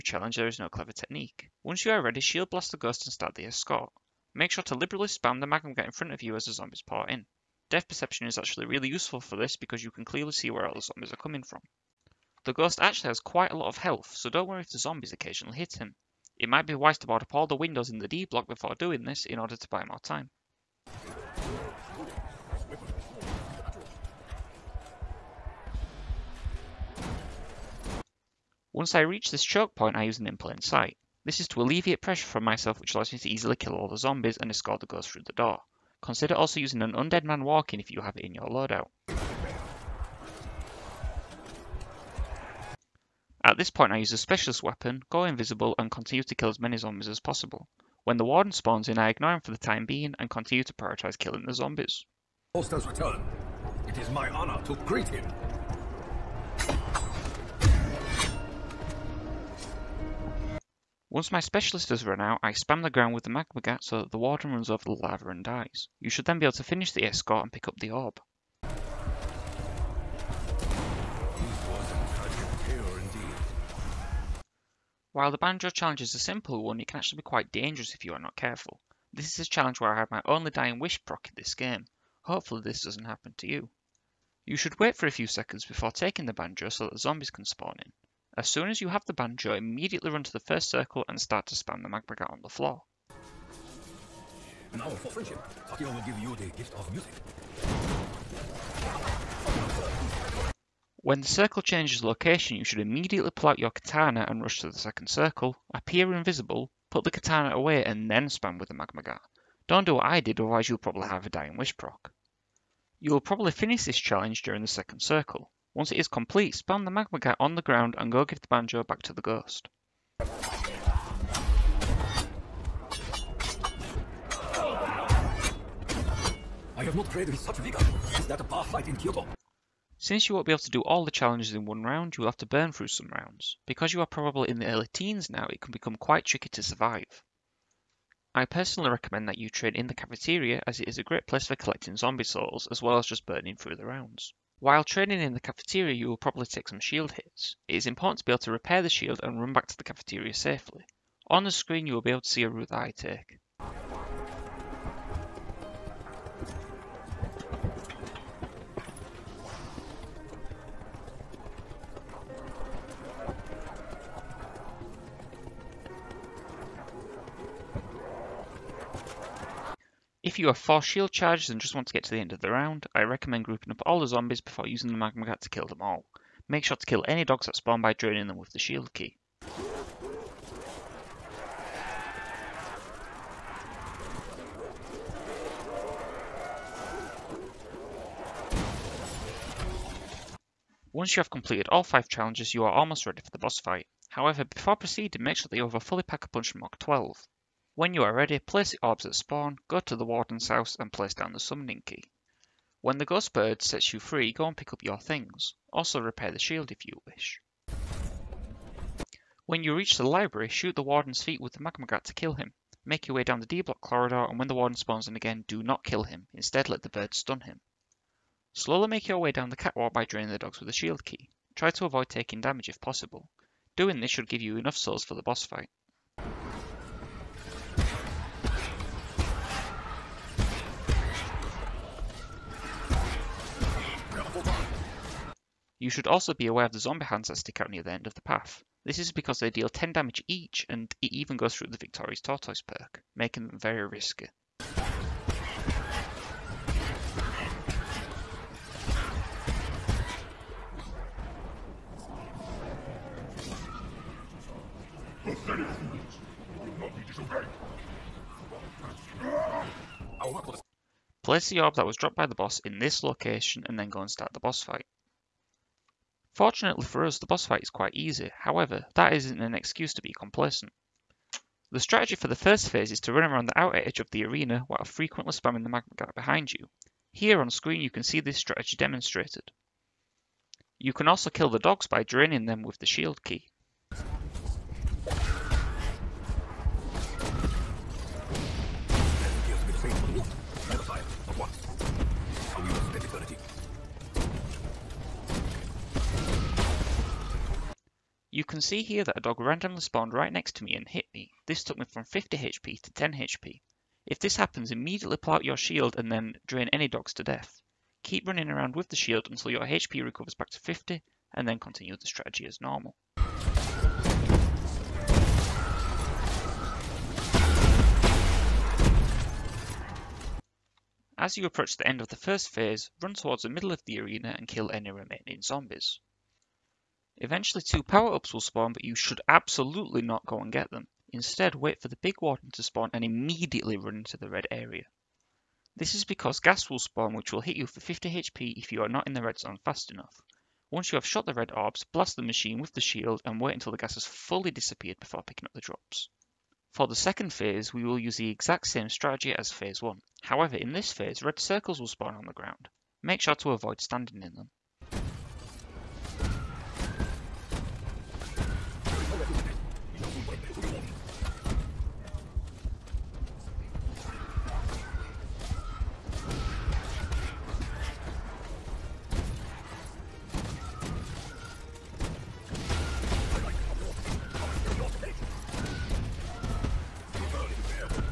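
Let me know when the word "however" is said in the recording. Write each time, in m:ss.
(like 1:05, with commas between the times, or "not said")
3:14, 4:28, 5:50.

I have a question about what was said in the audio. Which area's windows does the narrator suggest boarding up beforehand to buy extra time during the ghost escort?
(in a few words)
D block.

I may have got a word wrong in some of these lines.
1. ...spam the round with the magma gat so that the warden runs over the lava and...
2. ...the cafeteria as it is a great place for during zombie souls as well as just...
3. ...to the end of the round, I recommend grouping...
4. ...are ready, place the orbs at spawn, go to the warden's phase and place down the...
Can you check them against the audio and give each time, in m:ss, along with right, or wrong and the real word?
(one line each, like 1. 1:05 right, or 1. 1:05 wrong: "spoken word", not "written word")
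1. 1:02 wrong: "ground", not "round"
2. 2:19 wrong: "collecting", not "during"
3. 2:52 right
4. 3:18 wrong: "house", not "phase".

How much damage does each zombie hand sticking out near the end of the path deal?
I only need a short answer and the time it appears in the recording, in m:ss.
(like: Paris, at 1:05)
10, at 3:59.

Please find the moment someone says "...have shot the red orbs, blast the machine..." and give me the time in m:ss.
5:40.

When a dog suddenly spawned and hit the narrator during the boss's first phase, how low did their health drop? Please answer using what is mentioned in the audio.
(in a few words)
10 HP.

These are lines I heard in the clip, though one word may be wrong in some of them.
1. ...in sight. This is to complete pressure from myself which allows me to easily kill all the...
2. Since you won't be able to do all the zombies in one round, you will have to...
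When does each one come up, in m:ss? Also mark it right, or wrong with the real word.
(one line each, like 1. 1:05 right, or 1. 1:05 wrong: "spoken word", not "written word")
1. 0:30 wrong: "alleviate", not "complete"
2. 2:10 wrong: "challenges", not "zombies".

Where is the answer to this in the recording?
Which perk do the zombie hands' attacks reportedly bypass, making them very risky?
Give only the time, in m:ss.
4:01.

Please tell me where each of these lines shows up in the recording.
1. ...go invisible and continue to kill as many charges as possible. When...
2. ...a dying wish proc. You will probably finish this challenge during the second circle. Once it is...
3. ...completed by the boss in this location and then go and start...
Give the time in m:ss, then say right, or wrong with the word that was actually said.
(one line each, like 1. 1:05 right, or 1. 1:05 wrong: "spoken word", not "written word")
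1. 0:45 wrong: "zombies", not "charges"
2. 1:51 right
3. 4:21 wrong: "dropped", not "completed".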